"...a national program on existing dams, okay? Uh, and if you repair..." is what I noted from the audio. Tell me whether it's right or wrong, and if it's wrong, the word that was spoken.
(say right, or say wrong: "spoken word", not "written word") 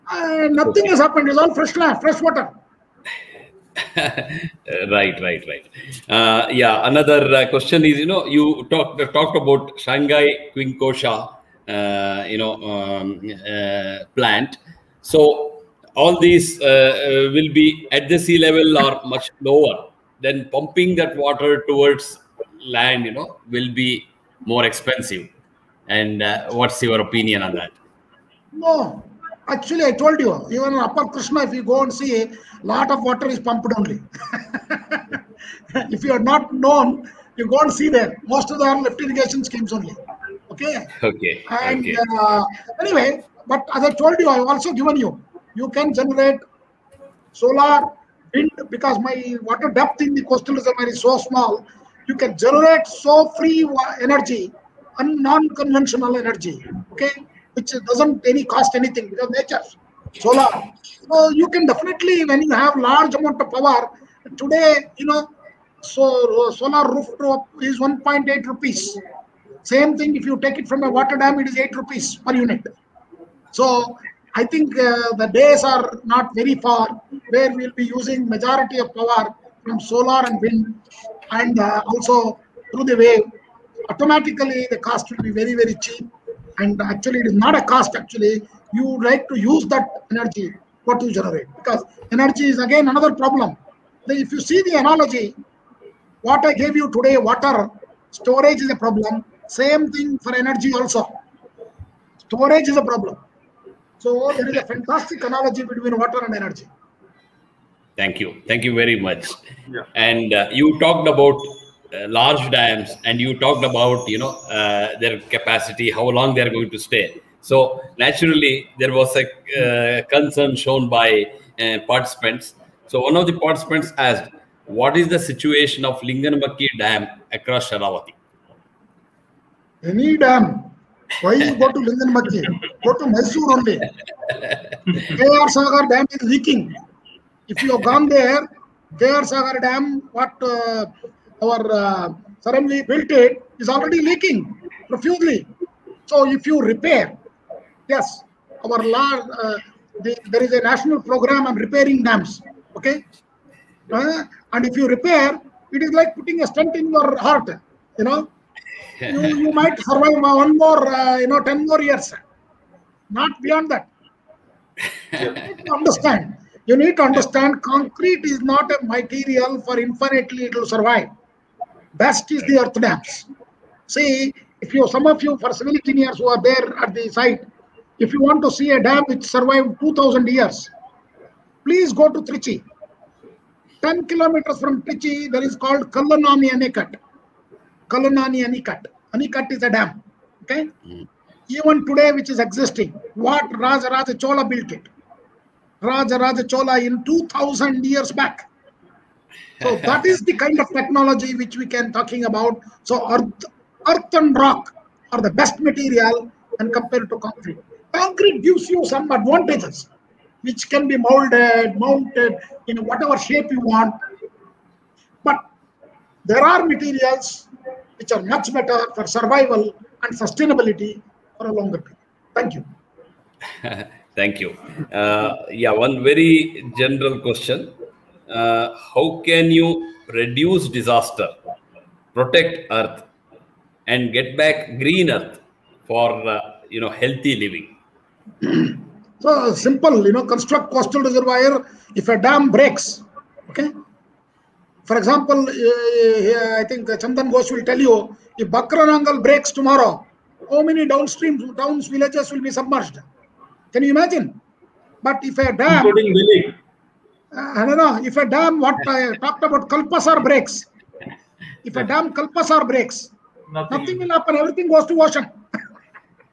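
wrong: "repairing", not "existing".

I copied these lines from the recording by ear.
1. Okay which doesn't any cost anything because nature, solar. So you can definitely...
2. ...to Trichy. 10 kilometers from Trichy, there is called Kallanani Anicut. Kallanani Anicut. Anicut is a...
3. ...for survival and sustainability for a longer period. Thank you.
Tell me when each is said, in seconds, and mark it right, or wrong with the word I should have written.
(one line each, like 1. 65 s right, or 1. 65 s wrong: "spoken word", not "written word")
1. 56 s right
2. 182 s right
3. 218 s right.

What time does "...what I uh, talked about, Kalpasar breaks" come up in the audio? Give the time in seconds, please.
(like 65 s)
258 s.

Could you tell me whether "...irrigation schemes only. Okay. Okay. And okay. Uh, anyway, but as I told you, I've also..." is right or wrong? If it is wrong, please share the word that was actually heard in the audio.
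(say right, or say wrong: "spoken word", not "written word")
right.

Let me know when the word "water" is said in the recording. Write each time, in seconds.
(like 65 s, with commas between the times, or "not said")
2 s, 21 s, 33 s, 49 s, 70 s, 97 s, 106 s.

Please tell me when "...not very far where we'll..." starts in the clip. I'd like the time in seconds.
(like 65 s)
76 s.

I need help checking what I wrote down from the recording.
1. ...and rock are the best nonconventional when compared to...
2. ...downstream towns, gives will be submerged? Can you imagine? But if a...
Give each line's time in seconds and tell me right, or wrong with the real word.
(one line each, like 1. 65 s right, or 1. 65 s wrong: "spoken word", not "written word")
1. 204 s wrong: "material", not "nonconventional"
2. 250 s wrong: "villages", not "gives".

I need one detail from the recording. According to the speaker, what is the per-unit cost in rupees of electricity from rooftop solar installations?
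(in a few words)
1.8 rupees.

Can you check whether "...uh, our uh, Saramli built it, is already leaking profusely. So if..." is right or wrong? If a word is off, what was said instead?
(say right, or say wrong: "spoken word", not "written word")
right.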